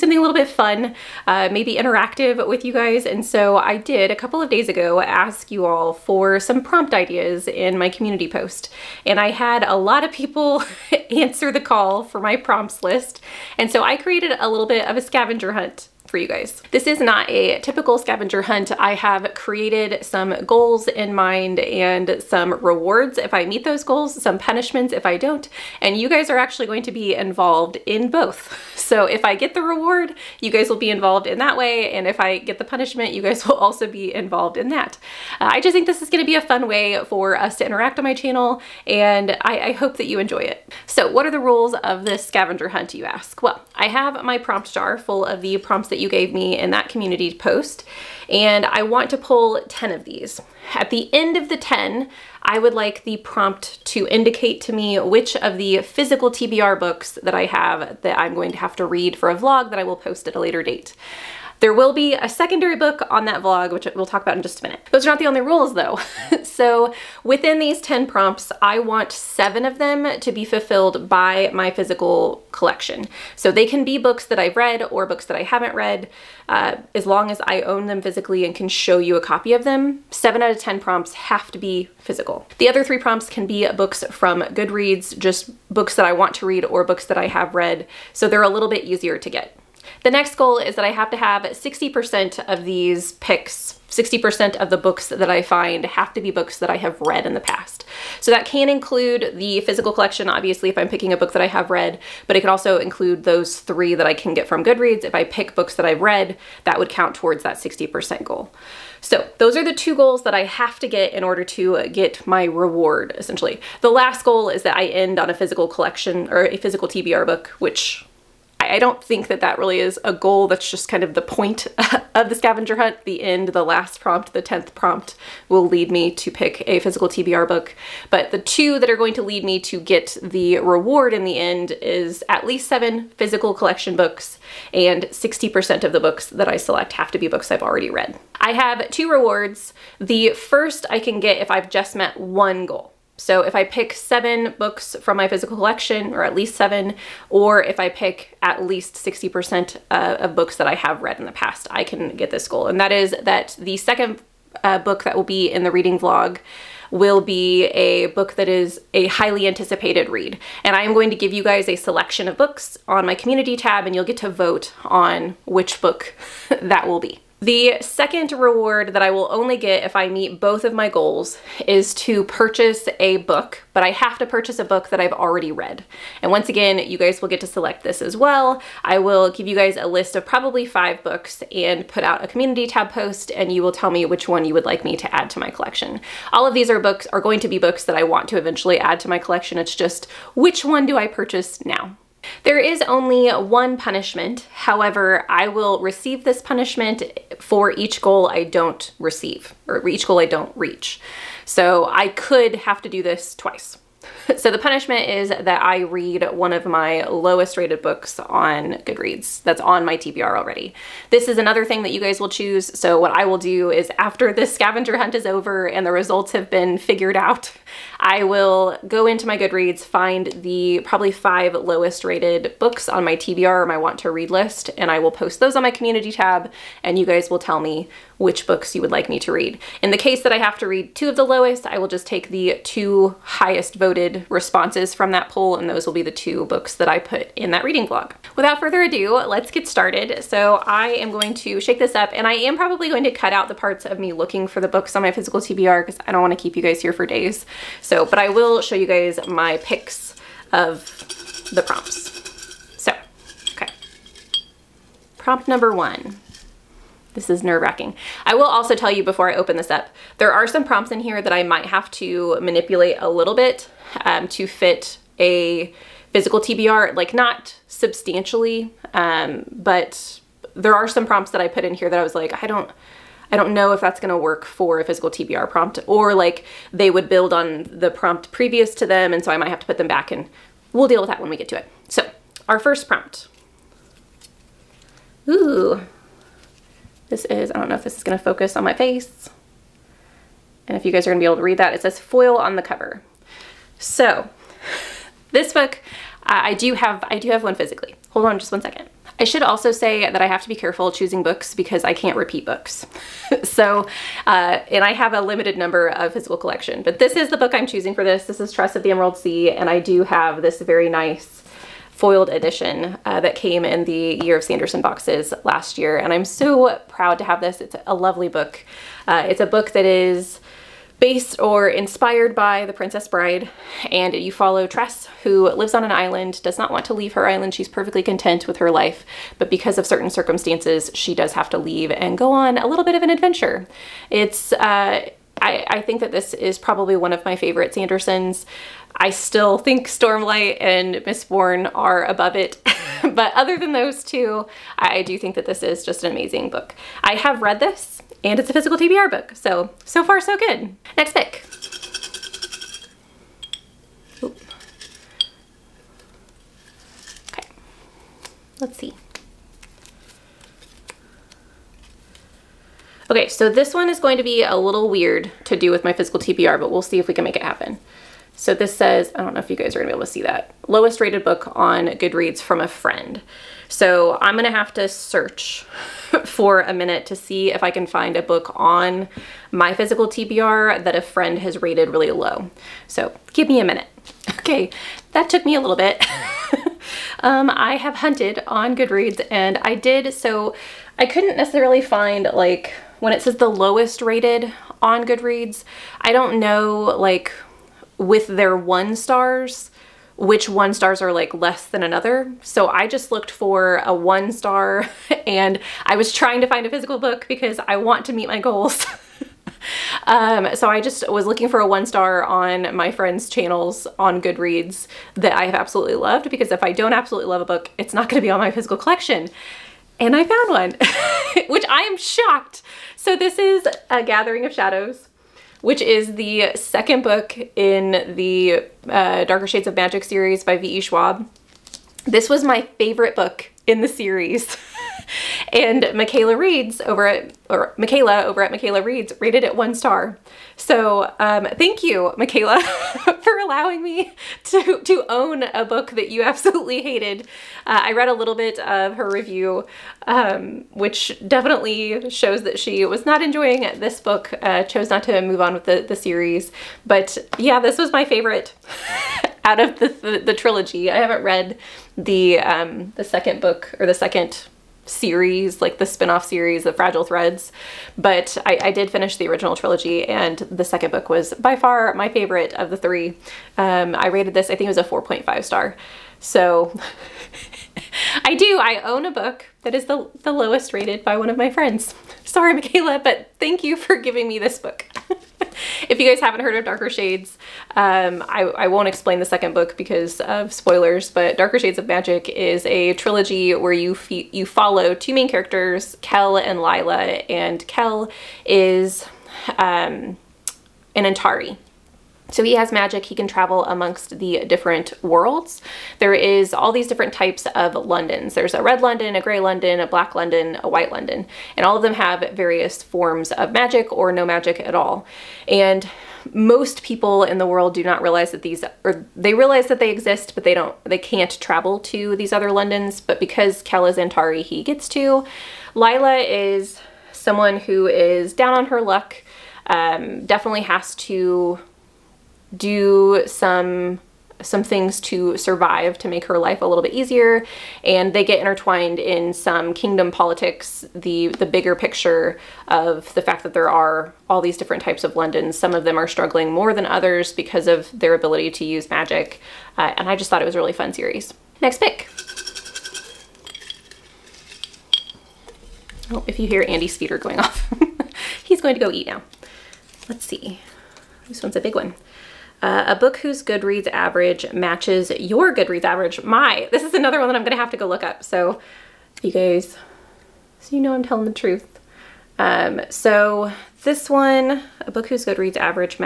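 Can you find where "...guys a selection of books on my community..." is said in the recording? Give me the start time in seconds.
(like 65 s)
161 s.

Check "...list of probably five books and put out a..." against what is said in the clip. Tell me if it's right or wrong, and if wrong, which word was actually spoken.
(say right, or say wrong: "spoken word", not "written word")
right.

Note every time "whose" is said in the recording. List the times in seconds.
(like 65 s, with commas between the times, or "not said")
563 s, 575 s.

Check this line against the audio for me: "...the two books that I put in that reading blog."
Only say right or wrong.
right.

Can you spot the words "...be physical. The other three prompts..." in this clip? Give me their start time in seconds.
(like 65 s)
81 s.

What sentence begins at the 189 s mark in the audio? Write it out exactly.
It's just which one do I purchase now?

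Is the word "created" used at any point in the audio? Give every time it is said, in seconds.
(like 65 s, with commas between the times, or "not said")
13 s, 19 s.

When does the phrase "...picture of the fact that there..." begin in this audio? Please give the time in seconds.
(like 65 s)
541 s.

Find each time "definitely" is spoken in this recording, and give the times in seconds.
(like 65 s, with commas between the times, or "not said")
451 s, 530 s.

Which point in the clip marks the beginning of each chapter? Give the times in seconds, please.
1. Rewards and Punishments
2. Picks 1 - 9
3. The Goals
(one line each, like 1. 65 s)
1. 137 s
2. 238 s
3. 15 s.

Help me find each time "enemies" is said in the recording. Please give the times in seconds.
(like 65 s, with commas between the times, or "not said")
not said.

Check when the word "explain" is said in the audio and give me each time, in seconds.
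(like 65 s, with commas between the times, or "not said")
488 s.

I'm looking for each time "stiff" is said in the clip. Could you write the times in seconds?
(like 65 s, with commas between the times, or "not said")
not said.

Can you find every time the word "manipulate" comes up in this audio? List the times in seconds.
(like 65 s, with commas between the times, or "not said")
262 s.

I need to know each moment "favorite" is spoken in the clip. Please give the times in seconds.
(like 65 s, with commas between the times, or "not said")
337 s, 432 s, 458 s, 472 s.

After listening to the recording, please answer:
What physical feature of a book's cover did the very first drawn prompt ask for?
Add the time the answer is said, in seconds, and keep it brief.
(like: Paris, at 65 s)
Foil, at 291 s.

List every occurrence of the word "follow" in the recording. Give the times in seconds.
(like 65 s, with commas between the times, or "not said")
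324 s, 494 s.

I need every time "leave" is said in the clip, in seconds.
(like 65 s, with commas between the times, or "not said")
326 s, 331 s.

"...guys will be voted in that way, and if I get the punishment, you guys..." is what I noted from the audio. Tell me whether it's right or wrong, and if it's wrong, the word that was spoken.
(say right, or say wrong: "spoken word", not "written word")
wrong: "involved", not "voted".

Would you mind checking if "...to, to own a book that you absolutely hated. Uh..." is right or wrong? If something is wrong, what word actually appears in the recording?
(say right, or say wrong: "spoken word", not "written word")
right.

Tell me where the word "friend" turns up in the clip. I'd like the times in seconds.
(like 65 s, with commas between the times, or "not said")
372 s, 381 s, 412 s, 481 s.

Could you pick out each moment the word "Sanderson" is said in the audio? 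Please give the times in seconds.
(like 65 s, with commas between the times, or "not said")
314 s, 337 s.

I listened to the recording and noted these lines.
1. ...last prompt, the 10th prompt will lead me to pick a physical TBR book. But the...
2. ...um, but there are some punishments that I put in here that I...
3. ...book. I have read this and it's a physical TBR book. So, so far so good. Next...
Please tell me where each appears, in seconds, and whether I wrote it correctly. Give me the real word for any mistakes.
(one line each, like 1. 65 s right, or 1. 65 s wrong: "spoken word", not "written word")
1. 123 s right
2. 268 s wrong: "prompts", not "punishments"
3. 346 s right.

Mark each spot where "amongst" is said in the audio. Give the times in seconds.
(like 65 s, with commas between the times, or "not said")
503 s.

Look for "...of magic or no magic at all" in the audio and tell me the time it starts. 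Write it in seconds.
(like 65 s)
513 s.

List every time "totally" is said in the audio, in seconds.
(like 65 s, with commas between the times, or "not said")
not said.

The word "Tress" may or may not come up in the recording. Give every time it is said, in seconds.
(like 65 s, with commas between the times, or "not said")
308 s, 324 s.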